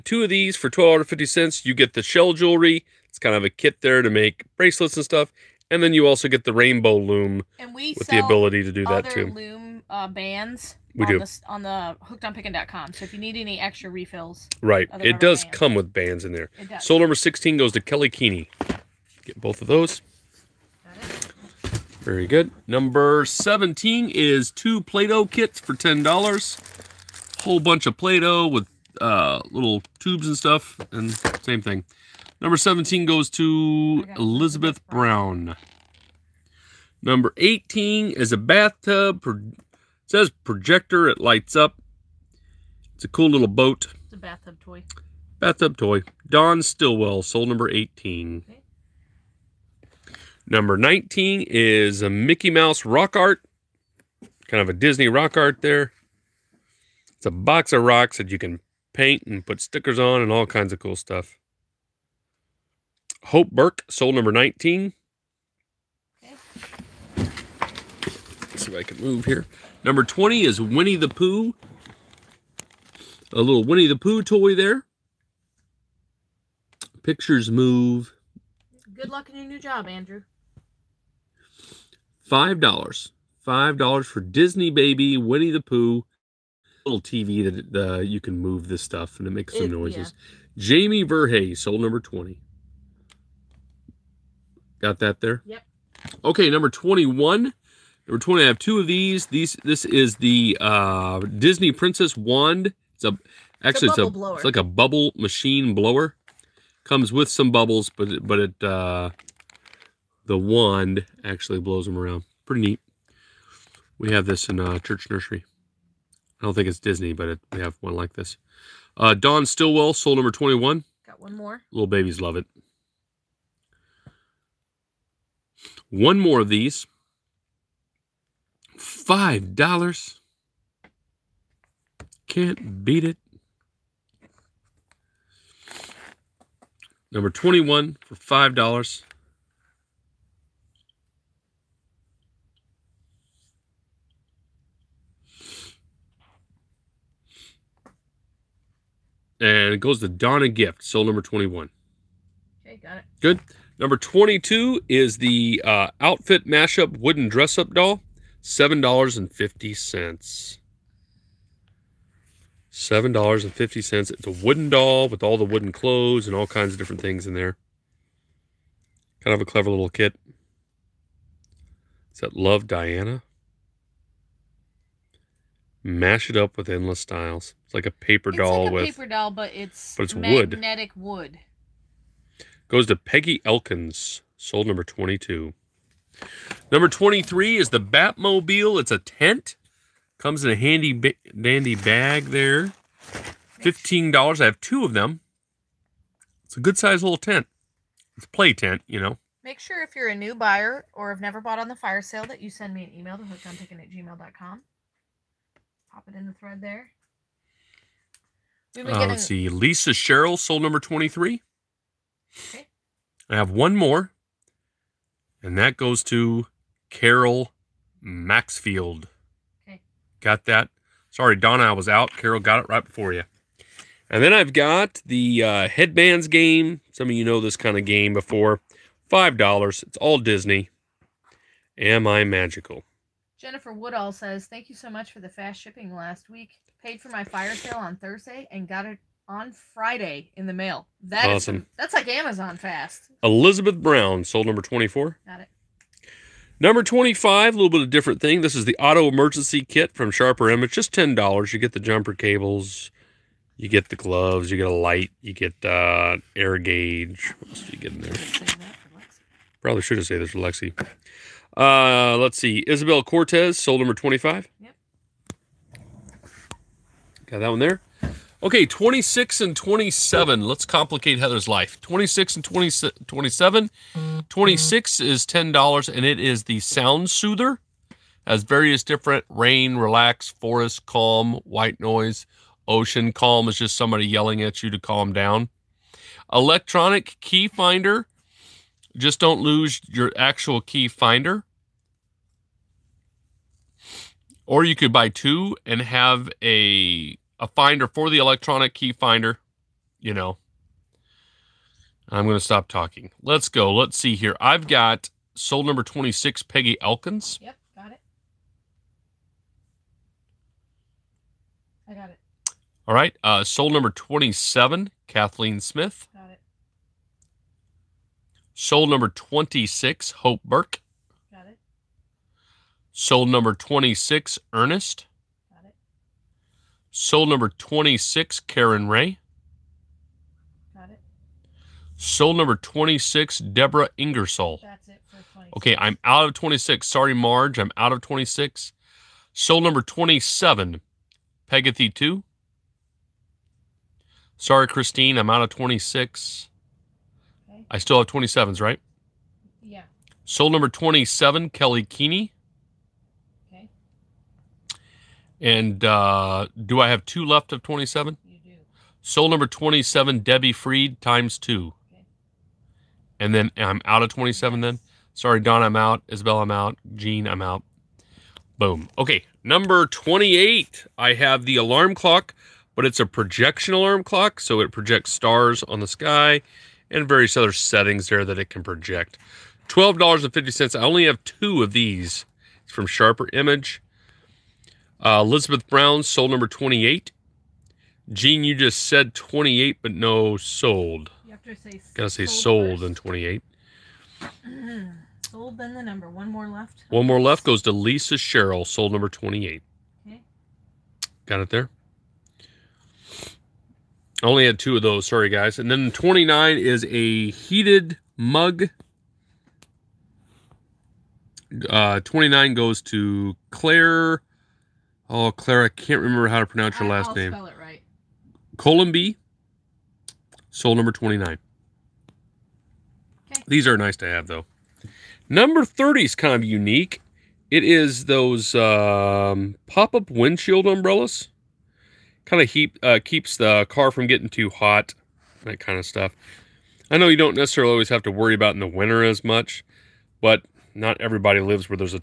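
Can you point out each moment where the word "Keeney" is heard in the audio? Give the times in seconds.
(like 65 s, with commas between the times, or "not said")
18 s, 351 s.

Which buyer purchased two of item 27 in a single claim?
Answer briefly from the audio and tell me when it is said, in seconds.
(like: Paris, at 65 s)
Debbie Freed, at 360 s.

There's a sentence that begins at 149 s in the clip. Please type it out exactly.
And it goes to Donna Gift, soul number 21.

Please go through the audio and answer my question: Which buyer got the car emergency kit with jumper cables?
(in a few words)
Isabel Cortez.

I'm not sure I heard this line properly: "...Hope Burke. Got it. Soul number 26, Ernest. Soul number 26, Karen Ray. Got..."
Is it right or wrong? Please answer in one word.
right.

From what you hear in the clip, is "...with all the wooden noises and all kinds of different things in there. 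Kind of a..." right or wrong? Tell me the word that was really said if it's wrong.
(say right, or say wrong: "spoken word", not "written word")
wrong: "clothes", not "noises".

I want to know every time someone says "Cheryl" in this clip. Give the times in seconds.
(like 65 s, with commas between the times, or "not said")
209 s, 398 s.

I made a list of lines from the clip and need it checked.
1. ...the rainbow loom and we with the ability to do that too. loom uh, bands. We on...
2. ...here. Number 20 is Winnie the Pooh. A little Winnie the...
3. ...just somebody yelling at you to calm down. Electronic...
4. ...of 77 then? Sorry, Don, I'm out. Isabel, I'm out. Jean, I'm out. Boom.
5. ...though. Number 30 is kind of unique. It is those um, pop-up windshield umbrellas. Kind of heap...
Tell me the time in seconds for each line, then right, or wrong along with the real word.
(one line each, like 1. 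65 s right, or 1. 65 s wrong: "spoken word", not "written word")
1. 6 s right
2. 69 s right
3. 283 s right
4. 364 s wrong: "27", not "77"
5. 424 s right.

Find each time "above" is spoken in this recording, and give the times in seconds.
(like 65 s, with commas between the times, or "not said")
not said.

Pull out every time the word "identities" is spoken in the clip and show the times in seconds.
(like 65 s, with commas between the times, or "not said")
not said.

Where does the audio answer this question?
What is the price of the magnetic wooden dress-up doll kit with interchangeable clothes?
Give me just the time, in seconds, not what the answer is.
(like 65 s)
158 s.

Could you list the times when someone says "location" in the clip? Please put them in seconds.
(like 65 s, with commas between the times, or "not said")
not said.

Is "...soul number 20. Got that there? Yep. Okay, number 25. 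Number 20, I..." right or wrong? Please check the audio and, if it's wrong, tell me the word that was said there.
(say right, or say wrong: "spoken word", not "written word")
wrong: "21", not "25".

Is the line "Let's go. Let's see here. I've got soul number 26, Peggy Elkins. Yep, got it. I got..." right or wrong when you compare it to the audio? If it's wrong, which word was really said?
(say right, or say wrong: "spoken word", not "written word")
right.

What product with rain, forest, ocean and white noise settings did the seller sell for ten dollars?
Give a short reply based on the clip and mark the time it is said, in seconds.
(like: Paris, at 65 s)
Sound Soother, at 276 s.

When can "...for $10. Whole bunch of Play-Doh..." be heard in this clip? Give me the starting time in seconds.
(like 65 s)
25 s.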